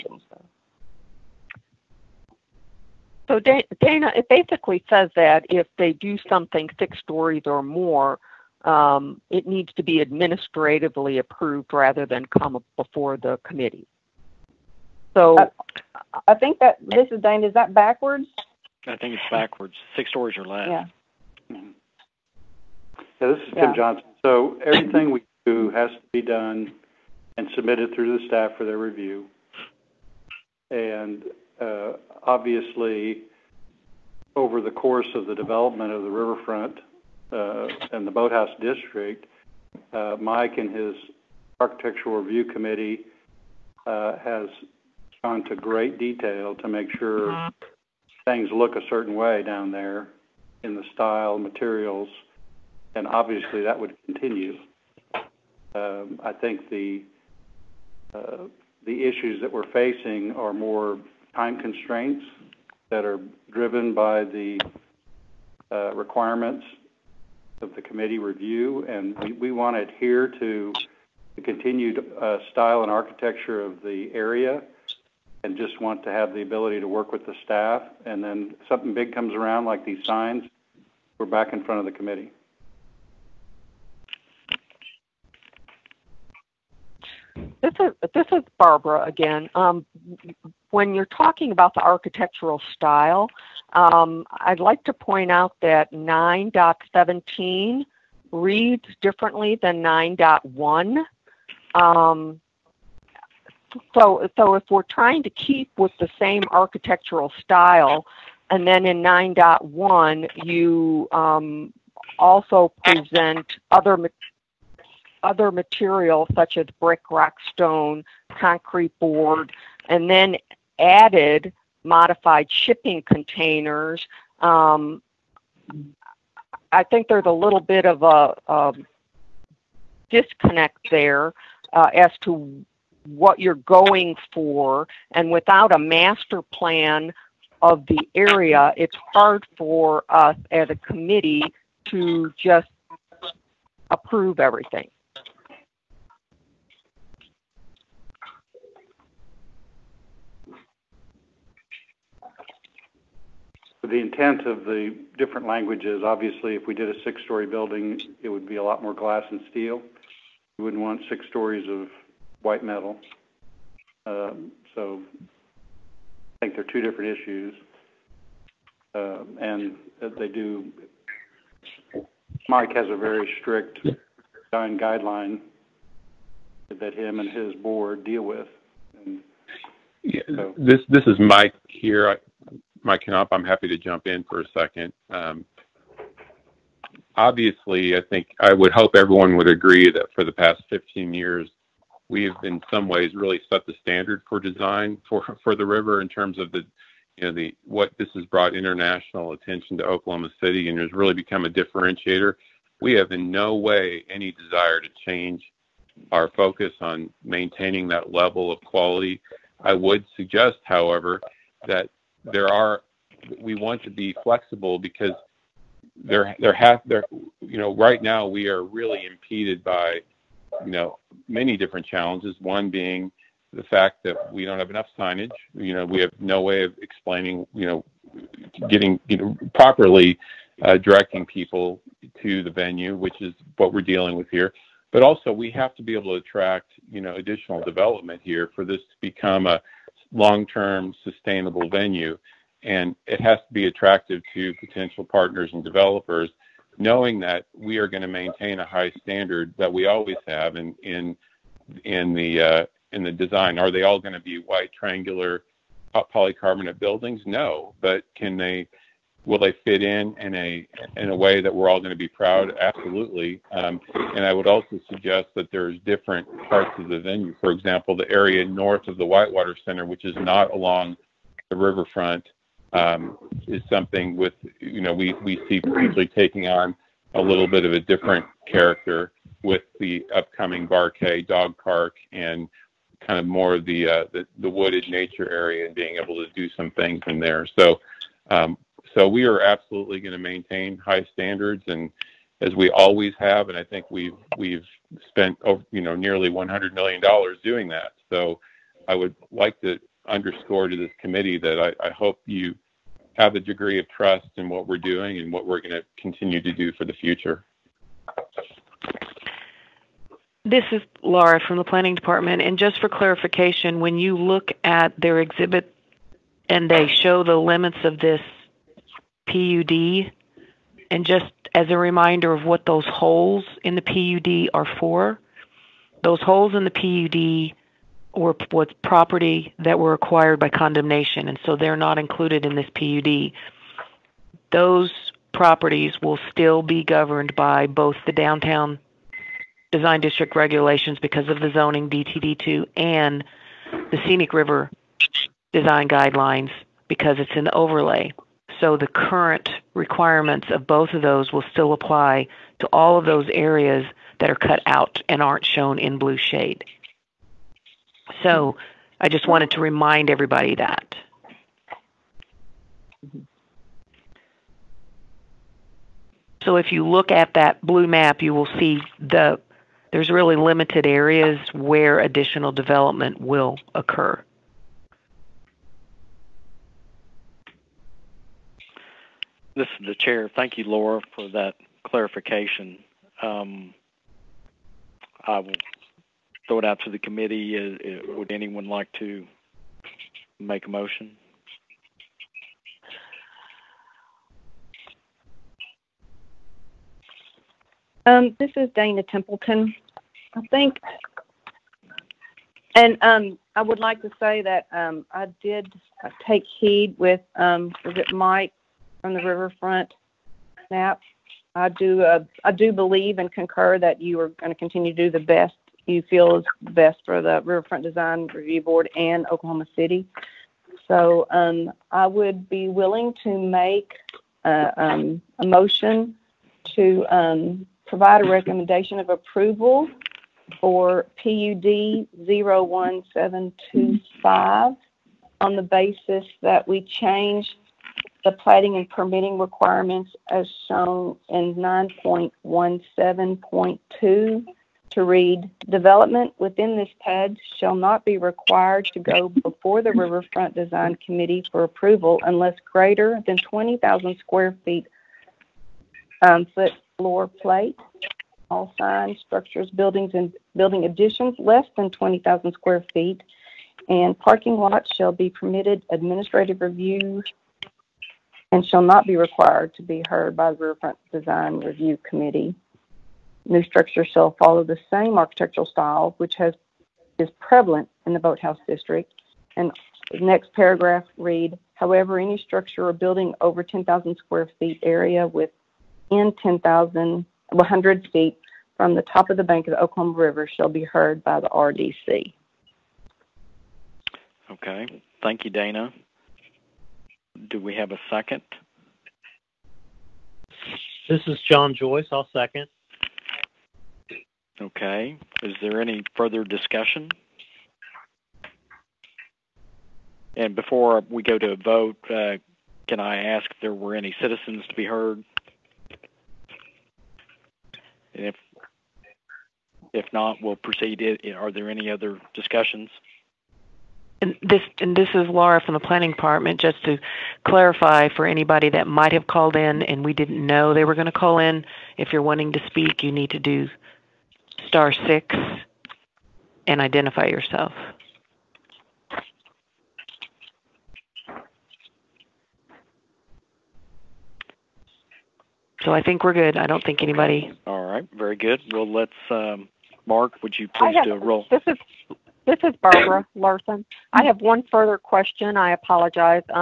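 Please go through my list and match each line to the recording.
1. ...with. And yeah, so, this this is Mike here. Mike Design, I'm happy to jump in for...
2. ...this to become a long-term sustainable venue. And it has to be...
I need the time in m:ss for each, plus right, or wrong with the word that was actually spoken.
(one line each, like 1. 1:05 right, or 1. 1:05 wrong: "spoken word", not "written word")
1. 2:58 wrong: "Knopp", not "Design"
2. 3:58 right.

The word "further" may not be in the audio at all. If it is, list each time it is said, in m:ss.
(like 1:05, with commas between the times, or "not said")
8:26, 9:14.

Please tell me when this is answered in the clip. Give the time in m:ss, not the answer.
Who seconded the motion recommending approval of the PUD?
8:21.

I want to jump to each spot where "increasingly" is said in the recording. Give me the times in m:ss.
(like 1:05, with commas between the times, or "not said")
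not said.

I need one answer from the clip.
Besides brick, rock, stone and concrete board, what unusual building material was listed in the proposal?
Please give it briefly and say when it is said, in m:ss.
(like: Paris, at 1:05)
modified shipping containers, at 2:01.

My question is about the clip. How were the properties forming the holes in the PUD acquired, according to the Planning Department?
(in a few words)
condemnation.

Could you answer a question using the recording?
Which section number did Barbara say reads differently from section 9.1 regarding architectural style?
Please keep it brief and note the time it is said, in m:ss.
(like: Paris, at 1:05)
9.17, at 1:35.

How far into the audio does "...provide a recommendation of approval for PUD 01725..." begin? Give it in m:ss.
7:07.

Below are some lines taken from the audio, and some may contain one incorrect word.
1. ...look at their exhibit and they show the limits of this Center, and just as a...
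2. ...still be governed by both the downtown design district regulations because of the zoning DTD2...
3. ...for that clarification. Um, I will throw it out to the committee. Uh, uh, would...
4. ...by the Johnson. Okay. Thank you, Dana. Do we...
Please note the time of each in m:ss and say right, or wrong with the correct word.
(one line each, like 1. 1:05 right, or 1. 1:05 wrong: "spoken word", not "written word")
1. 5:14 wrong: "PUD", not "Center"
2. 5:36 right
3. 6:21 right
4. 8:11 wrong: "RDC", not "Johnson".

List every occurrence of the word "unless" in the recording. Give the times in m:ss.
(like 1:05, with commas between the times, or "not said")
7:32.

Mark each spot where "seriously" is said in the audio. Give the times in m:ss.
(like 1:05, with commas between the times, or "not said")
not said.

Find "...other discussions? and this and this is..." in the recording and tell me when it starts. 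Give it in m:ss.
8:41.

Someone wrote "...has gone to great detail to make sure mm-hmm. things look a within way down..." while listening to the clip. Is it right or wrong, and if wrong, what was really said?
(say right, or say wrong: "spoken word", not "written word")
wrong: "certain", not "within".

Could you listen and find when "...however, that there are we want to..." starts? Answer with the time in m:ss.
3:30.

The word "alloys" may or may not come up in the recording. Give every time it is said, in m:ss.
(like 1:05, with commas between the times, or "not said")
not said.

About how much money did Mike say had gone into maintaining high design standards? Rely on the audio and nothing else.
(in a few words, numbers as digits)
nearly $100 million.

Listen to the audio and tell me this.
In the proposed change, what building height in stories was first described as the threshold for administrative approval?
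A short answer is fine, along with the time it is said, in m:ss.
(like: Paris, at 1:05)
6, at 0:06.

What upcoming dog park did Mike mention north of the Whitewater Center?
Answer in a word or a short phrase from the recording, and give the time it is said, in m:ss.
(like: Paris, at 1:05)
Barkay Dog Park, at 4:40.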